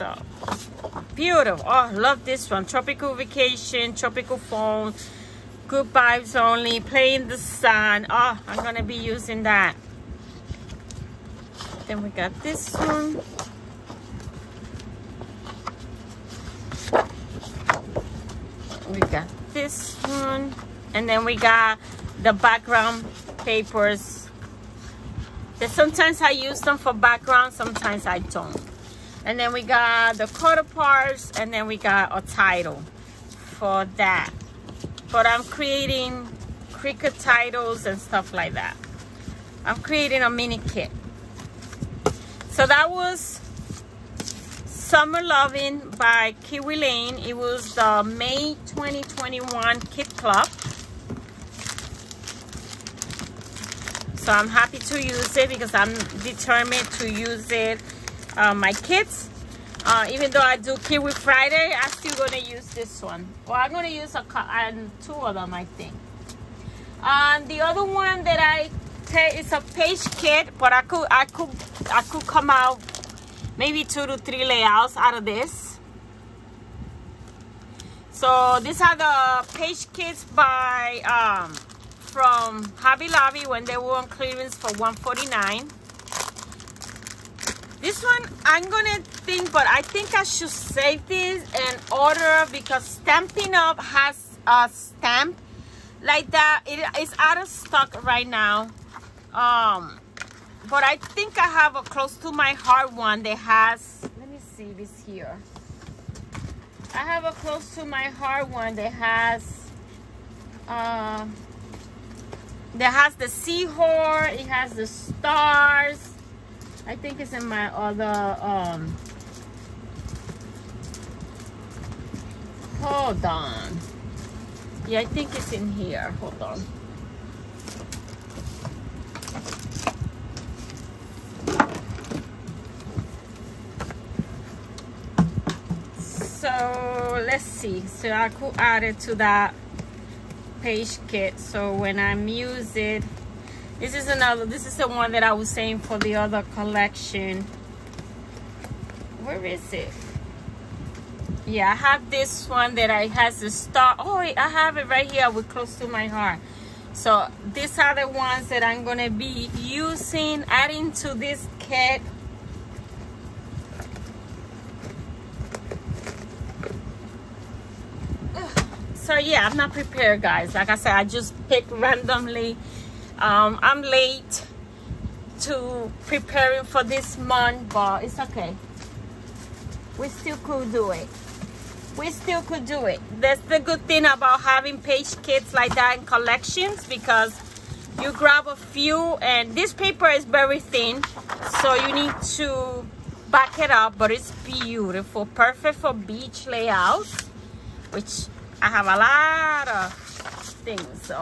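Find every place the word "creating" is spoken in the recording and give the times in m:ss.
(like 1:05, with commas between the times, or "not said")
0:35, 0:39.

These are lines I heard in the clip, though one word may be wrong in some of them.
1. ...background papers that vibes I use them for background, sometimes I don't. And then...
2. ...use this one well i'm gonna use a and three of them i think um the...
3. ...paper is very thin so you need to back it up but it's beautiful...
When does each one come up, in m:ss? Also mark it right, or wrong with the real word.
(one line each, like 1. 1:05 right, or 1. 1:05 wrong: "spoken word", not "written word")
1. 0:22 wrong: "sometimes", not "vibes"
2. 1:02 wrong: "two", not "three"
3. 3:09 right.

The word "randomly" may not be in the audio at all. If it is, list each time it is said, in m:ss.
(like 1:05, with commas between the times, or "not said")
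2:51.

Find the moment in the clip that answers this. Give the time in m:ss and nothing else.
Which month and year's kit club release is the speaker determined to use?
0:48.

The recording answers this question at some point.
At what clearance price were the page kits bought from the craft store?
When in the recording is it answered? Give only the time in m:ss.
1:24.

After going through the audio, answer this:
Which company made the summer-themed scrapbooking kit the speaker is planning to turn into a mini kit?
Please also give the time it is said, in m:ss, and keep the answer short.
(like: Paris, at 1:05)
Kiwi Lane, at 0:46.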